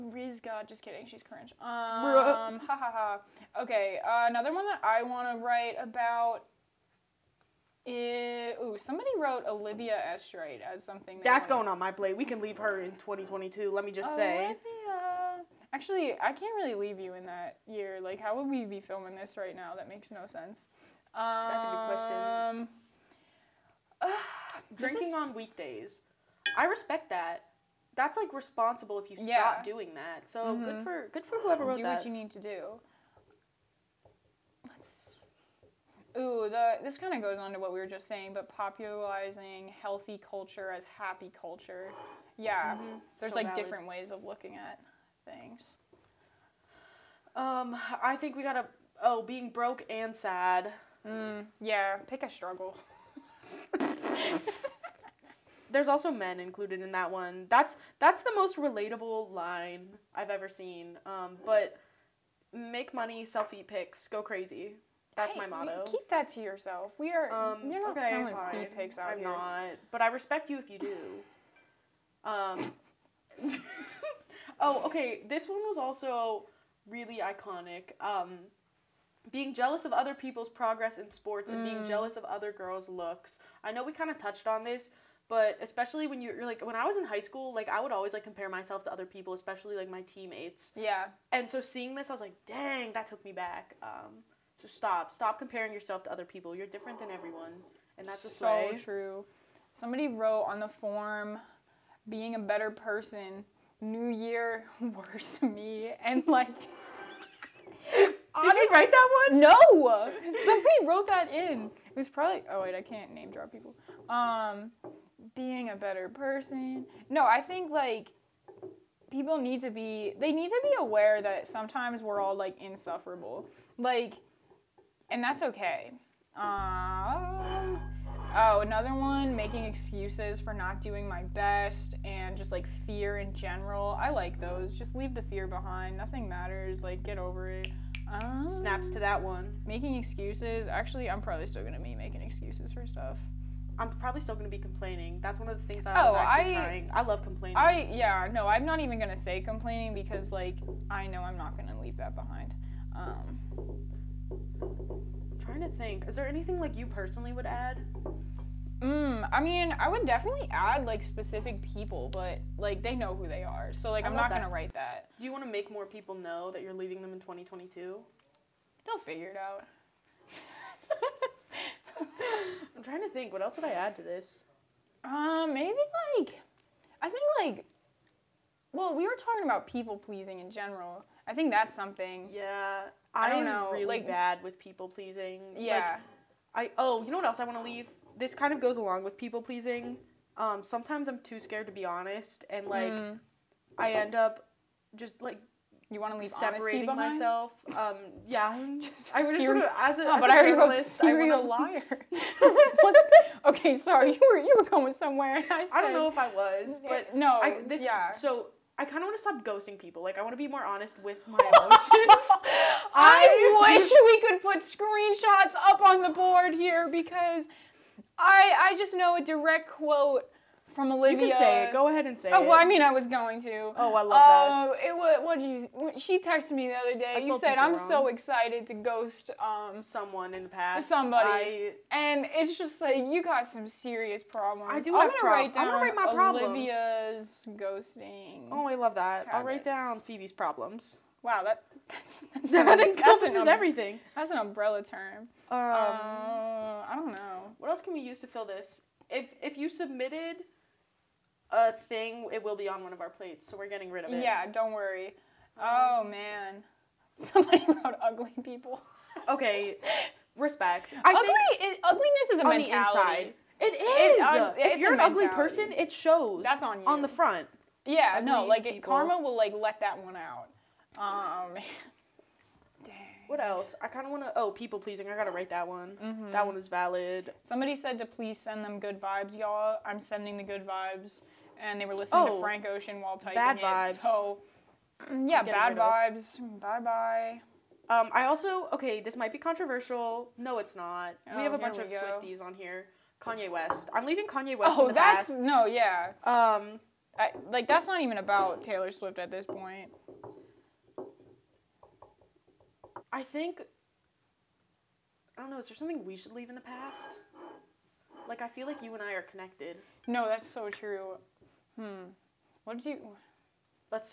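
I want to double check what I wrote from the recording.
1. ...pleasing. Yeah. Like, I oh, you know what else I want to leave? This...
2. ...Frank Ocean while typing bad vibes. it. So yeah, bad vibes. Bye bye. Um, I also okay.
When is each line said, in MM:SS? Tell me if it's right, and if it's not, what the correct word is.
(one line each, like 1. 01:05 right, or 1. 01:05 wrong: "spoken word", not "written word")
1. 03:04 right
2. 04:42 right.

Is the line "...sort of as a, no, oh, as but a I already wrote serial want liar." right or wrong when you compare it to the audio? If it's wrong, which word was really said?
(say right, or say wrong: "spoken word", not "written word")
right.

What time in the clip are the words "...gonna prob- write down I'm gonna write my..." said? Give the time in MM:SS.
03:55.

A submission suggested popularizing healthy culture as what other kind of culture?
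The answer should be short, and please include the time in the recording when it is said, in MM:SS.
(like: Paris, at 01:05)
happy culture, at 00:40.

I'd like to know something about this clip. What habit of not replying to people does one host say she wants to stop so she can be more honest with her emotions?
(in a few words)
ghosting people.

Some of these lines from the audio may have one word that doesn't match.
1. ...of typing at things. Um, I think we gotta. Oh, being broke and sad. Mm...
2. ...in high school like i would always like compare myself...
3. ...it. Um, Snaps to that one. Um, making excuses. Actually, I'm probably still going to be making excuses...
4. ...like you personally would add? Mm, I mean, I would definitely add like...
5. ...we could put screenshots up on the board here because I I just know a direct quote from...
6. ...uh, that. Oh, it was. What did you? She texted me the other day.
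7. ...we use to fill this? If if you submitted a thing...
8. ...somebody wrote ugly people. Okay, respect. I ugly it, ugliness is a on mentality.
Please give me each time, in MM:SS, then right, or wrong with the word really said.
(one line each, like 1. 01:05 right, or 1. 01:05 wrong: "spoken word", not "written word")
1. 00:44 wrong: "looking", not "typing"
2. 01:26 right
3. 02:17 right
4. 02:36 right
5. 03:33 right
6. 03:44 right
7. 04:07 right
8. 04:17 right.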